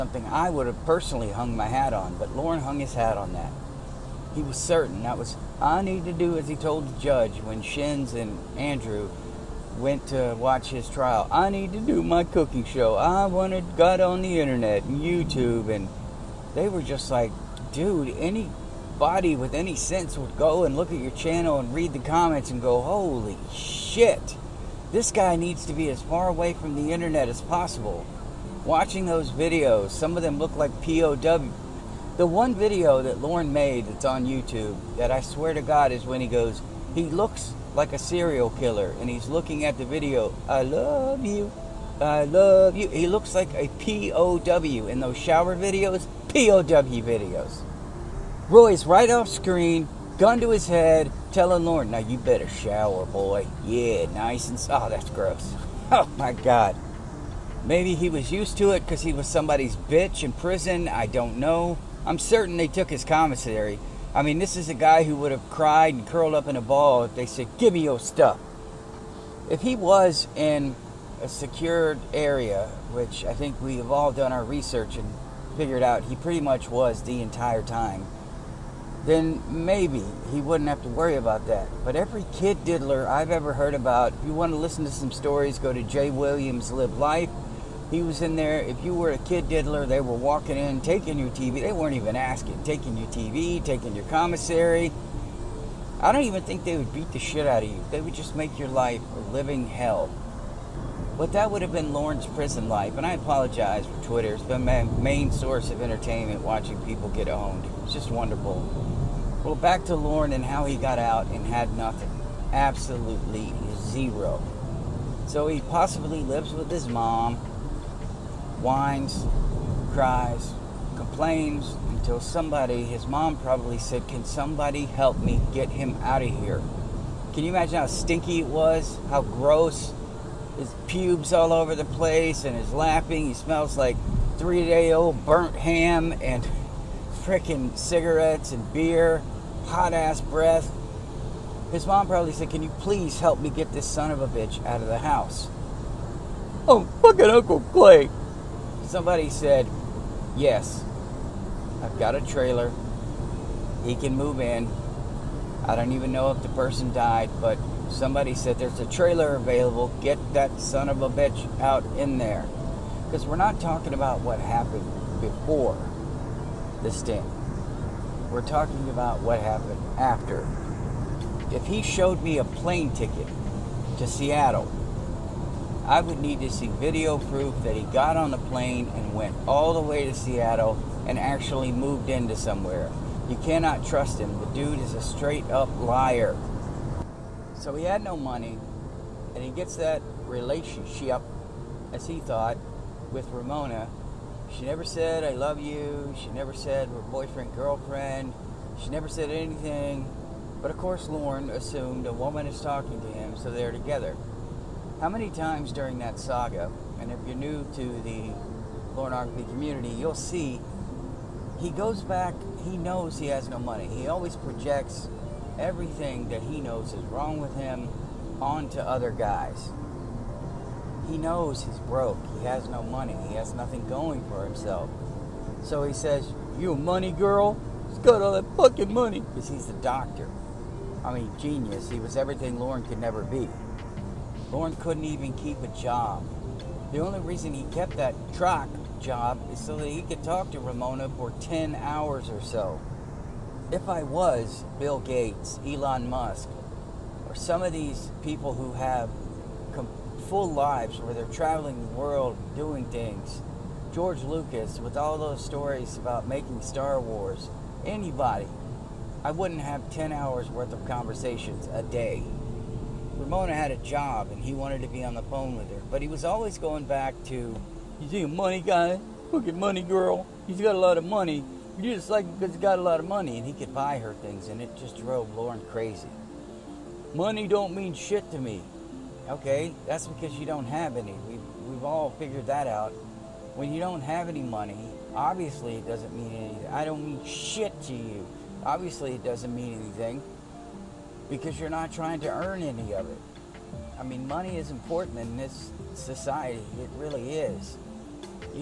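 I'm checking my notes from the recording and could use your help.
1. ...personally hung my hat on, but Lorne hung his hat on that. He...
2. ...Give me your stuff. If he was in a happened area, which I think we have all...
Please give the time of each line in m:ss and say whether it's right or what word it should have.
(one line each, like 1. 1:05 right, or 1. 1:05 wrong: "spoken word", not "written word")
1. 0:00 right
2. 1:07 wrong: "secured", not "happened".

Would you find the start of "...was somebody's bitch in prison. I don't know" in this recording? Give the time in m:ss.
0:59.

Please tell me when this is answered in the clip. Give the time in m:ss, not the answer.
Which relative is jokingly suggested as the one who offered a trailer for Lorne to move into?
2:27.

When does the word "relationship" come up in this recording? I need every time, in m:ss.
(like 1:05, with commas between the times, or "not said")
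3:10.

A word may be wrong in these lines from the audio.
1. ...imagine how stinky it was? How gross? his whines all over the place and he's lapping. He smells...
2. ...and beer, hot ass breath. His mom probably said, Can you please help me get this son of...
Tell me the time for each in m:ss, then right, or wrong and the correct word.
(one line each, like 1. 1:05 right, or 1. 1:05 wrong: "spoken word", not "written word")
1. 2:07 wrong: "pubes", not "whines"
2. 2:18 right.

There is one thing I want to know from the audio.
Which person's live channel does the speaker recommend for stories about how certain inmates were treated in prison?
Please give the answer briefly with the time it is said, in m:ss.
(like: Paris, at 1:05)
Jay Williams, at 1:25.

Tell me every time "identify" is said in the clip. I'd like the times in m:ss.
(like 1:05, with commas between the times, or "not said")
not said.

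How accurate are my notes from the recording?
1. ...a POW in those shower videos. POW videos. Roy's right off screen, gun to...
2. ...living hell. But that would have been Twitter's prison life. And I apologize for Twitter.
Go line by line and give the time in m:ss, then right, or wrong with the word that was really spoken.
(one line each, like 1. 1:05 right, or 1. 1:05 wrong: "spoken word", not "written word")
1. 0:43 right
2. 1:39 wrong: "Lorne", not "Twitter".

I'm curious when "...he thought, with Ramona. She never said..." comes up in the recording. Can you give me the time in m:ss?
3:12.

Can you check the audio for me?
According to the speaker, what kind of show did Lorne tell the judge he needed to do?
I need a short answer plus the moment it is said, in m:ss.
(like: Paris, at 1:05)
cooking show, at 0:12.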